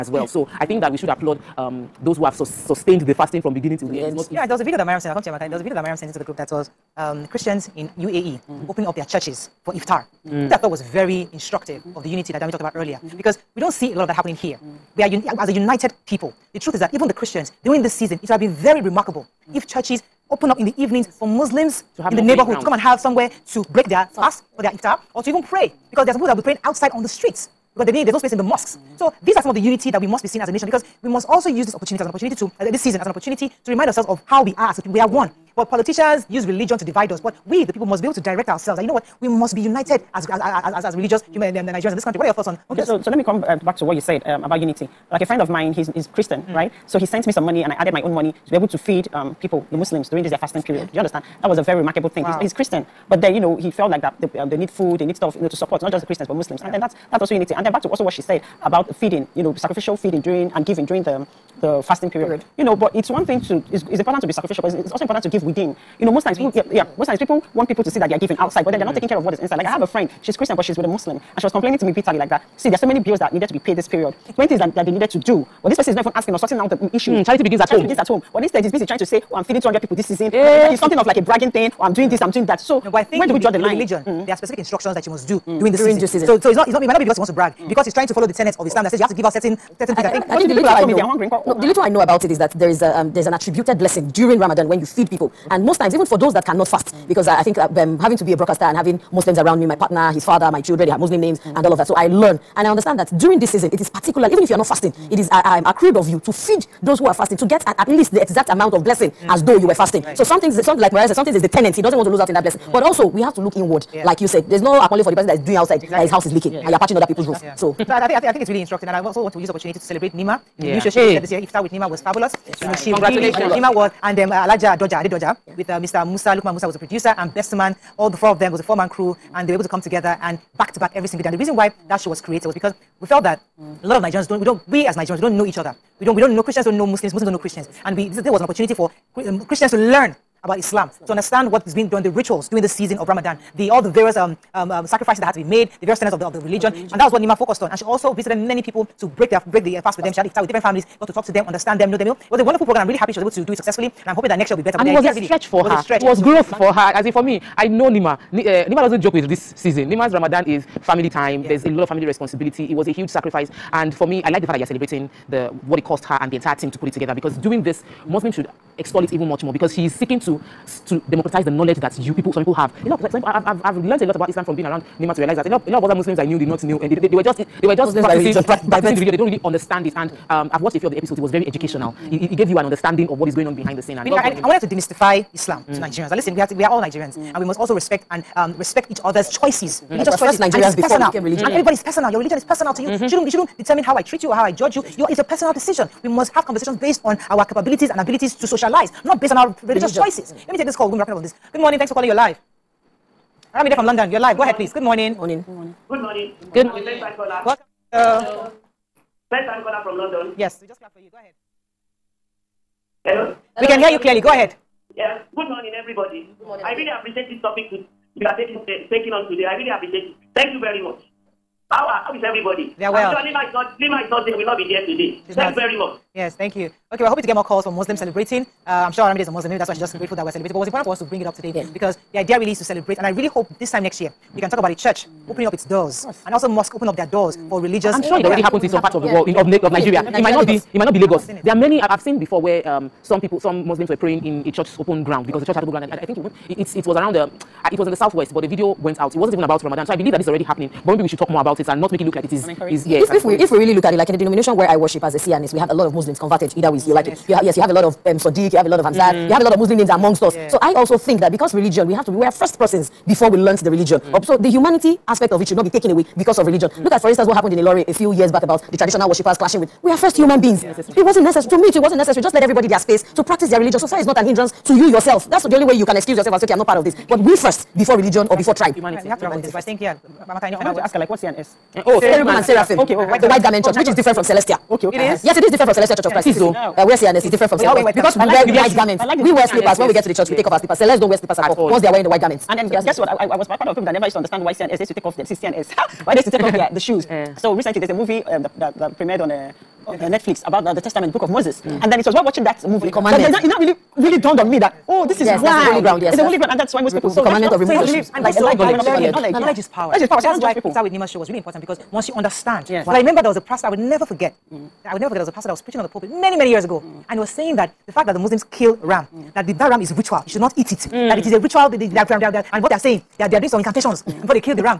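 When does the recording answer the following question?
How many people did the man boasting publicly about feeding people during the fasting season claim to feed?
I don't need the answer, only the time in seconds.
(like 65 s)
79 s.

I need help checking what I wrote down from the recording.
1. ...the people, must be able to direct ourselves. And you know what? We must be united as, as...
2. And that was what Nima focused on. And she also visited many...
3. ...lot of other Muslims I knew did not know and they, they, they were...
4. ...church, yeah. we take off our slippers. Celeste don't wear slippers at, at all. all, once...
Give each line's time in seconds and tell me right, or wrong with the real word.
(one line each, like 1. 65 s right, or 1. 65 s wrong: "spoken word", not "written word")
1. 37 s right
2. 146 s right
3. 175 s right
4. 290 s right.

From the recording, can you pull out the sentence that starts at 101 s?
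So I learn and I understand that during this season, it is particularly even if you are not fasting, mm.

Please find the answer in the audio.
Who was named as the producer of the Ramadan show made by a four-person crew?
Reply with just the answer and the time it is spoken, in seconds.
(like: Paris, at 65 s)
Lukman Musa, at 126 s.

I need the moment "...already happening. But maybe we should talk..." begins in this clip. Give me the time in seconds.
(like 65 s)
250 s.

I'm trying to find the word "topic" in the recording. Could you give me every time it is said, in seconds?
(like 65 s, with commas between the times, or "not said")
217 s.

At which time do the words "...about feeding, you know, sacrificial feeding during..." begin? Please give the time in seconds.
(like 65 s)
58 s.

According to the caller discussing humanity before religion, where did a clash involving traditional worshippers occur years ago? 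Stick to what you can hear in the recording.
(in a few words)
Ilorin.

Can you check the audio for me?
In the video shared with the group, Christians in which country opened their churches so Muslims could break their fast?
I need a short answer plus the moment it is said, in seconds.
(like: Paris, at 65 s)
UAE, at 7 s.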